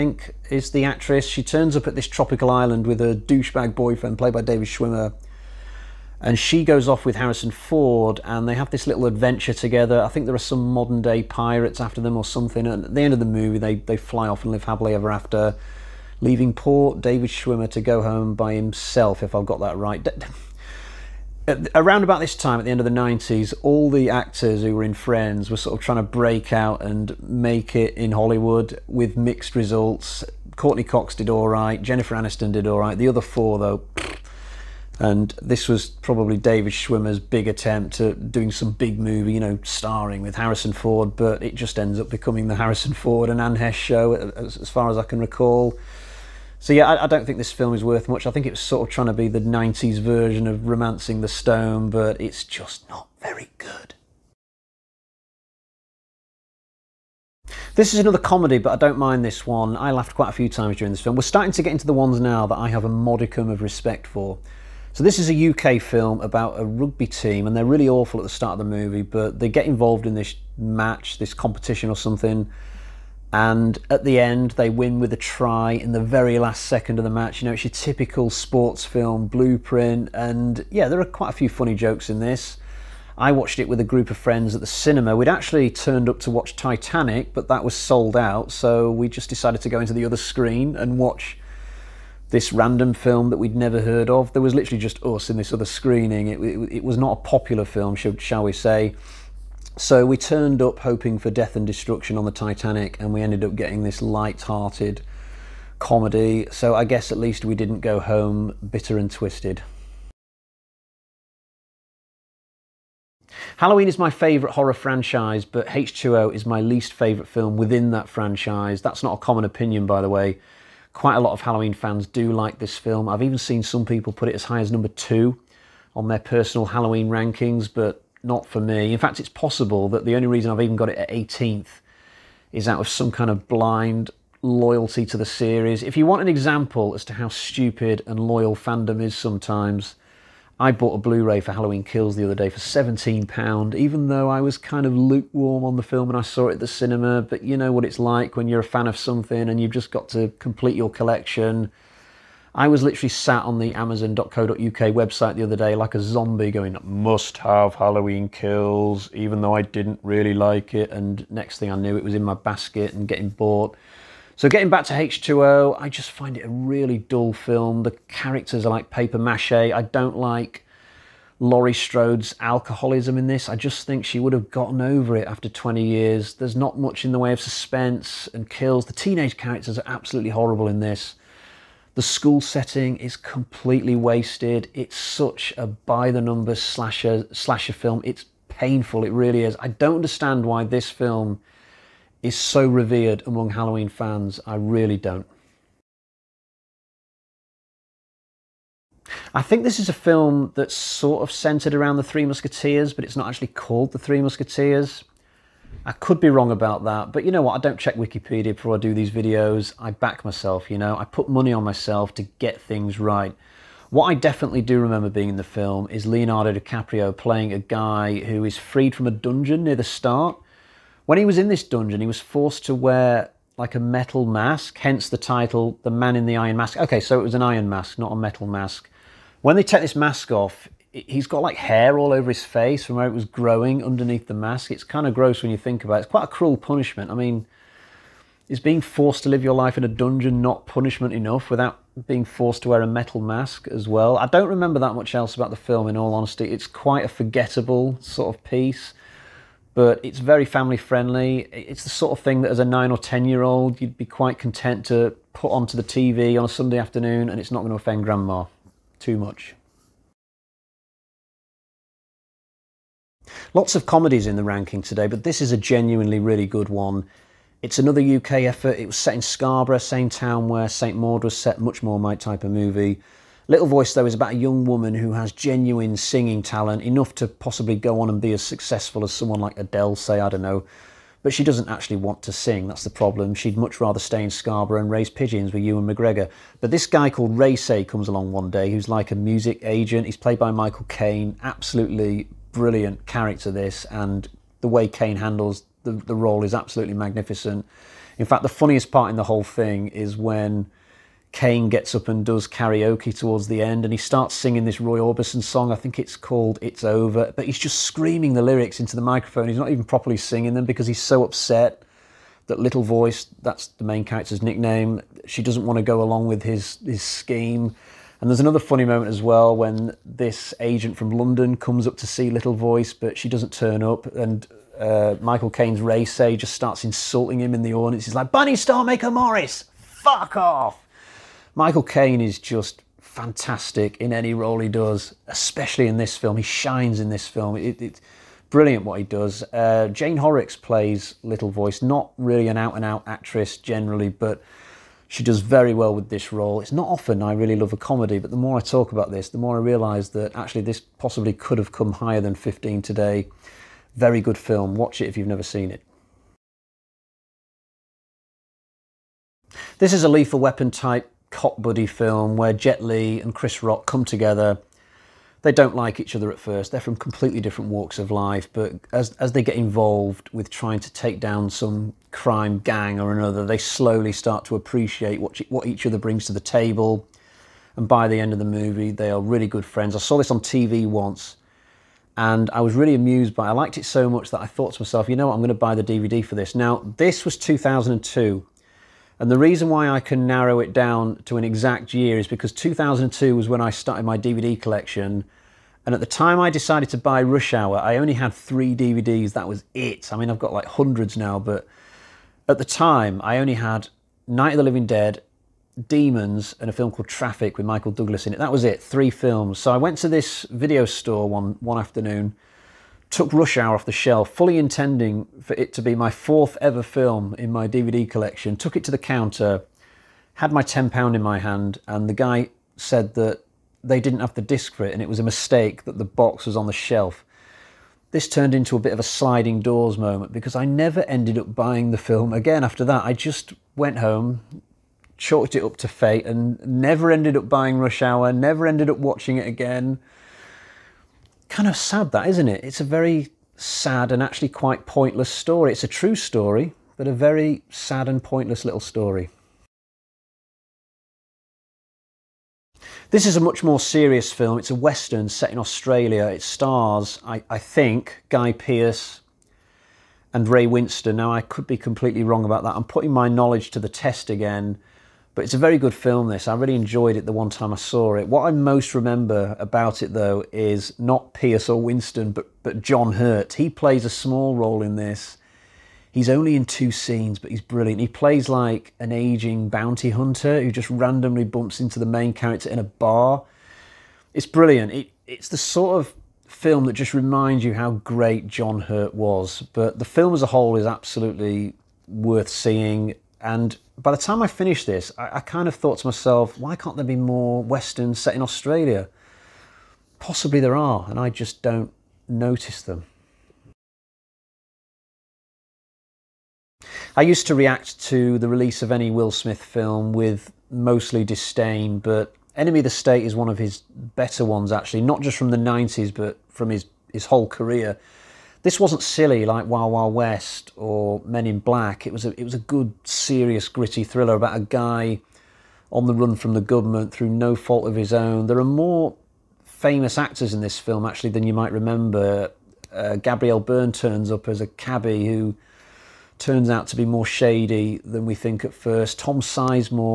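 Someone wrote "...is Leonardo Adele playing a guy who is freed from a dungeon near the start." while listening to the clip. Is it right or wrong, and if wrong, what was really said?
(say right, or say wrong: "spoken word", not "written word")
wrong: "DiCaprio", not "Adele".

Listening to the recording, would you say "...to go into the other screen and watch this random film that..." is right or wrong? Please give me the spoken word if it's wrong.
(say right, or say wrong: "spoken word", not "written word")
right.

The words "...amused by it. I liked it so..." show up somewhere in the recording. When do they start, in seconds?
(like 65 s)
382 s.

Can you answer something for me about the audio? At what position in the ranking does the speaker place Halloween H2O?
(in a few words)
18th.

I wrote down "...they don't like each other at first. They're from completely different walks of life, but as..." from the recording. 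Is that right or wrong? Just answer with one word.
right.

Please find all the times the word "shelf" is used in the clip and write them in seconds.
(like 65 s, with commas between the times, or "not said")
413 s, 426 s.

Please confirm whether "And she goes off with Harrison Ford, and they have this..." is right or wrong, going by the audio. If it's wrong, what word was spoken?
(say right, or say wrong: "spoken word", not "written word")
right.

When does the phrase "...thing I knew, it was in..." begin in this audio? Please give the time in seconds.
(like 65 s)
161 s.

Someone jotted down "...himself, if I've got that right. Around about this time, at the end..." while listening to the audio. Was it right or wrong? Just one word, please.
right.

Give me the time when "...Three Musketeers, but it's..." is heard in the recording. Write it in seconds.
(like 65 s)
202 s.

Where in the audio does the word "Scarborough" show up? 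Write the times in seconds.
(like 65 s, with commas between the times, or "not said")
269 s, 284 s.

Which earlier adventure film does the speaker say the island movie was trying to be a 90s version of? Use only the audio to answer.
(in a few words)
Romancing the Stone.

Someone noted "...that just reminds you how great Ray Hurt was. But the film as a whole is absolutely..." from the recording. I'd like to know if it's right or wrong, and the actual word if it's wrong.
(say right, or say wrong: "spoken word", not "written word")
wrong: "John", not "Ray".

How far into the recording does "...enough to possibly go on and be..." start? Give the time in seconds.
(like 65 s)
276 s.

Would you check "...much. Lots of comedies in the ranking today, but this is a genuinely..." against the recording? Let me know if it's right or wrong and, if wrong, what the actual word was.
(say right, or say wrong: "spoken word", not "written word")
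right.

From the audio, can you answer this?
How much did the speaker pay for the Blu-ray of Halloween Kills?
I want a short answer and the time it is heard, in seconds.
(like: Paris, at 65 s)
£17, at 142 s.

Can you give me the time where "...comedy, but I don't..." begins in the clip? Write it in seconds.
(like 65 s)
58 s.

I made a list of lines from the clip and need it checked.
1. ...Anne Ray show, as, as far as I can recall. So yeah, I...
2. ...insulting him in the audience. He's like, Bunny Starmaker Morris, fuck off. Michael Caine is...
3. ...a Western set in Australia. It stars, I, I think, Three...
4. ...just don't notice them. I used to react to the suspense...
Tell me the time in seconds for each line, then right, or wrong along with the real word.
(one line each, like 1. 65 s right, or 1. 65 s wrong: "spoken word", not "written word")
1. 43 s wrong: "Heche", not "Ray"
2. 326 s right
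3. 454 s wrong: "Guy", not "Three"
4. 501 s wrong: "release", not "suspense".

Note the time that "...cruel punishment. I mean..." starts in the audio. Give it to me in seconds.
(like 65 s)
236 s.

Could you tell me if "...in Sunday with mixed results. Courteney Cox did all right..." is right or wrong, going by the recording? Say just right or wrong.
wrong.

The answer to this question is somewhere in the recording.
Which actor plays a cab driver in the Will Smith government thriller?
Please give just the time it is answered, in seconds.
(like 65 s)
533 s.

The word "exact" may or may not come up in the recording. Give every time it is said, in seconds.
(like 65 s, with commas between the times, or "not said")
391 s.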